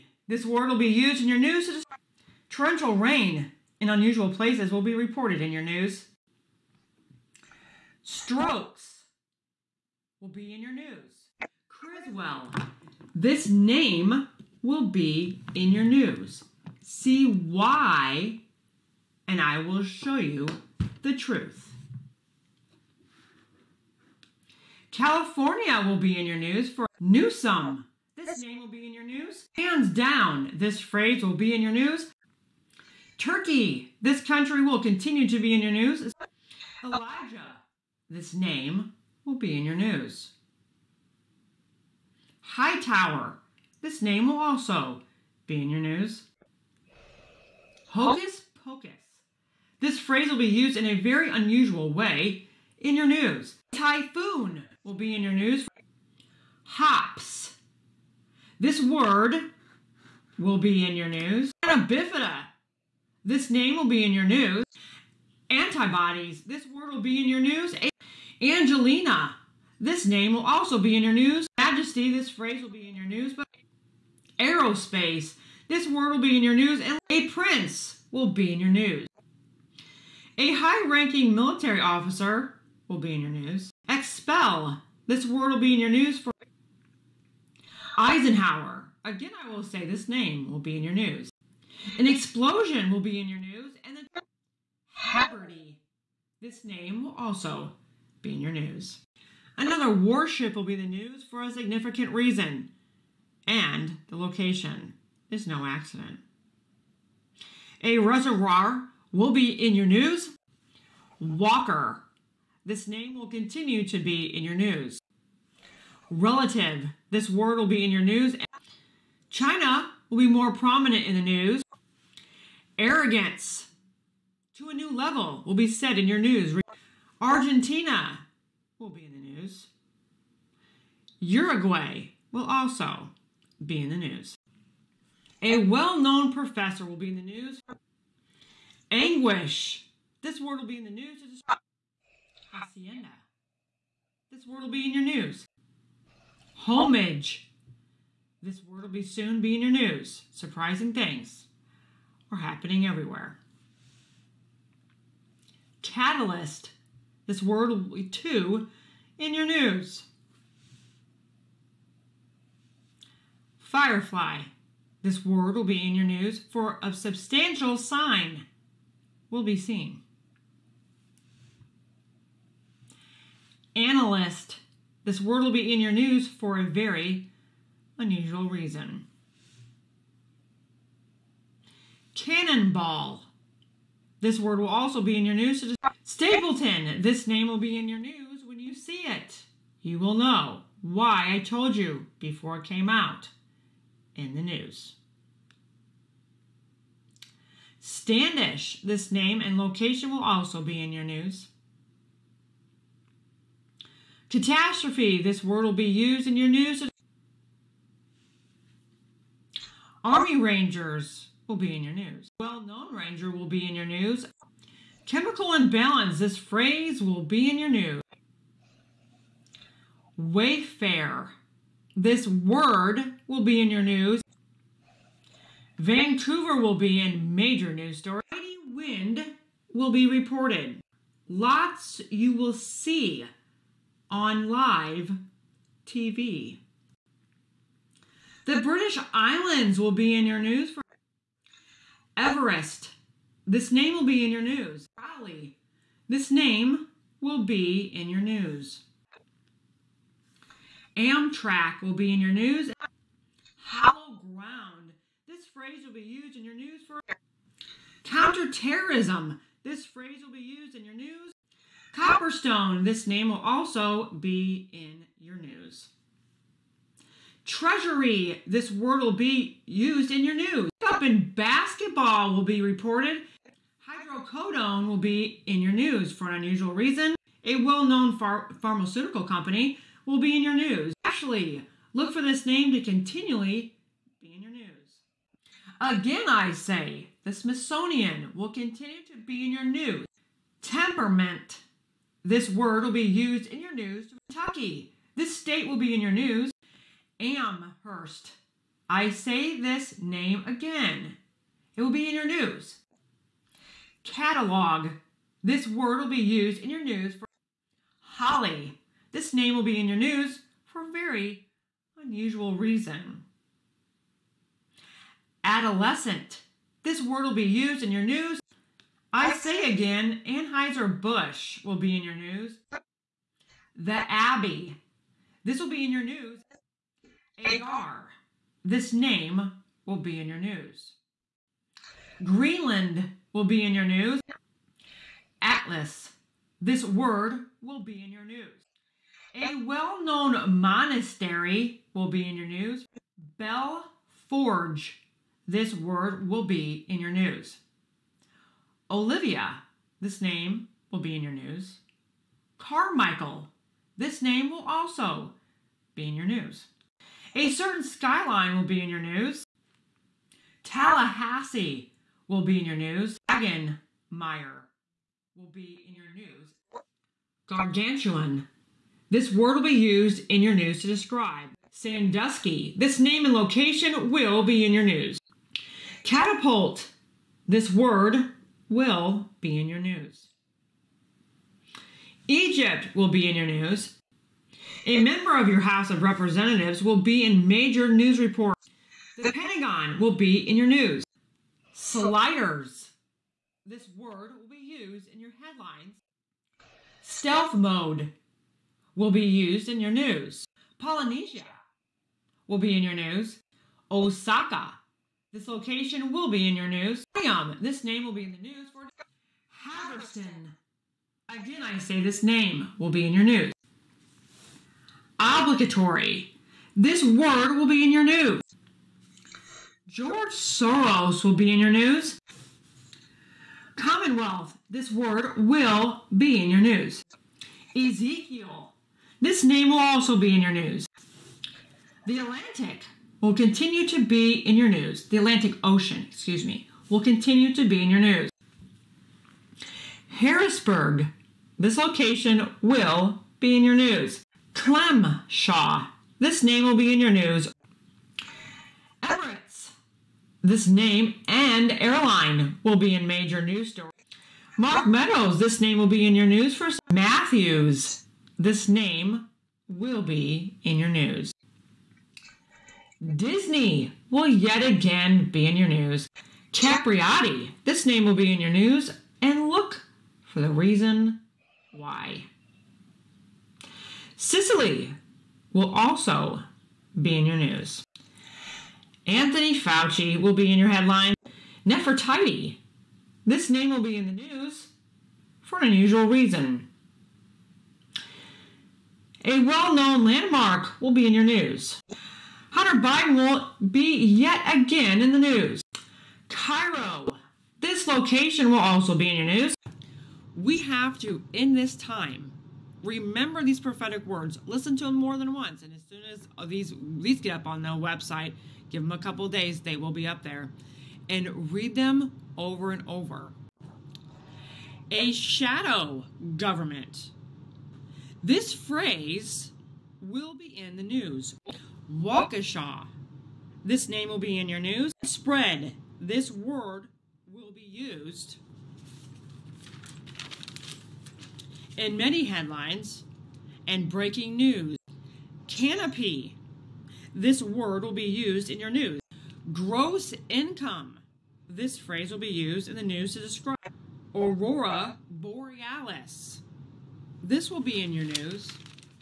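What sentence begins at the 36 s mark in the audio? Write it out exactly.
Elijah, this name will be in your news.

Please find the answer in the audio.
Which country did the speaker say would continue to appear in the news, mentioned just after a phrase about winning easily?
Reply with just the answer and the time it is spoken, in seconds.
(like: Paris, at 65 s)
Turkey, at 33 s.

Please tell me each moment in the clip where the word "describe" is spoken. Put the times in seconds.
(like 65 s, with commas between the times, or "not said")
1 s, 370 s, 543 s.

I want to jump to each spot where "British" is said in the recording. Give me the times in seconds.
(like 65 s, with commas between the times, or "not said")
238 s.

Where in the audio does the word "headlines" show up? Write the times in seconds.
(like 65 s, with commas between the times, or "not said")
395 s, 480 s, 532 s.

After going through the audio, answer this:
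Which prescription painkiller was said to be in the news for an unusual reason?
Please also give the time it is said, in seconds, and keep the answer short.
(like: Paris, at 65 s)
Hydrocodone, at 273 s.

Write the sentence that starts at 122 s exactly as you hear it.
Arrogance to a new level will be said in your news.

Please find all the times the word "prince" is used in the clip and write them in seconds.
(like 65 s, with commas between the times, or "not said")
77 s.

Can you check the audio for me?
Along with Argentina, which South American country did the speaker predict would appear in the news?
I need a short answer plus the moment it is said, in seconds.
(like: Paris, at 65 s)
Uruguay, at 131 s.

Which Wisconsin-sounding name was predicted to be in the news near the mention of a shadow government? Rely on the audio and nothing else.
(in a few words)
Waukesha.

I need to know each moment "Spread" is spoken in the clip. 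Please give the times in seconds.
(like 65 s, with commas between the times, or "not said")
525 s.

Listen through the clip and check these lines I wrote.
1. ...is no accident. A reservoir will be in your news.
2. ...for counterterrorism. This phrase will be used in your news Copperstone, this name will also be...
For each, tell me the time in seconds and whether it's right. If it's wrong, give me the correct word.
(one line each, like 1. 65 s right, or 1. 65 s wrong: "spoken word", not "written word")
1. 105 s right
2. 256 s right.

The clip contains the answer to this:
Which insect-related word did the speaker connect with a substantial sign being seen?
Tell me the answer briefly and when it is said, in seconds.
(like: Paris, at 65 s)
Firefly, at 163 s.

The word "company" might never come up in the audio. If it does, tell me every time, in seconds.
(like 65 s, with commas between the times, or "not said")
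279 s.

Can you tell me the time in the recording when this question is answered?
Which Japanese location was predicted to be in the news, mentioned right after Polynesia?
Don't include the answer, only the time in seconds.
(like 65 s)
403 s.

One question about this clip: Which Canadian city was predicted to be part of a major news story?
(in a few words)
Vancouver.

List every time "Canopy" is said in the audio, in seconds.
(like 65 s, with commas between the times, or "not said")
535 s.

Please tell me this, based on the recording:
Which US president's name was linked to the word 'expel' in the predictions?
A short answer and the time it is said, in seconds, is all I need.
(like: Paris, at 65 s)
Eisenhower, at 88 s.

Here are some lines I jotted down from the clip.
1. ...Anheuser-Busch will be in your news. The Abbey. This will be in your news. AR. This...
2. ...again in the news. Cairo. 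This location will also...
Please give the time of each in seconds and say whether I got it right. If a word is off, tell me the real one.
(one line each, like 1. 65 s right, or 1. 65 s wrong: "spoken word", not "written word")
1. 320 s right
2. 494 s right.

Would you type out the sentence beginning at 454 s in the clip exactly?
Mark Meadows, this name will be in your news for Matthews.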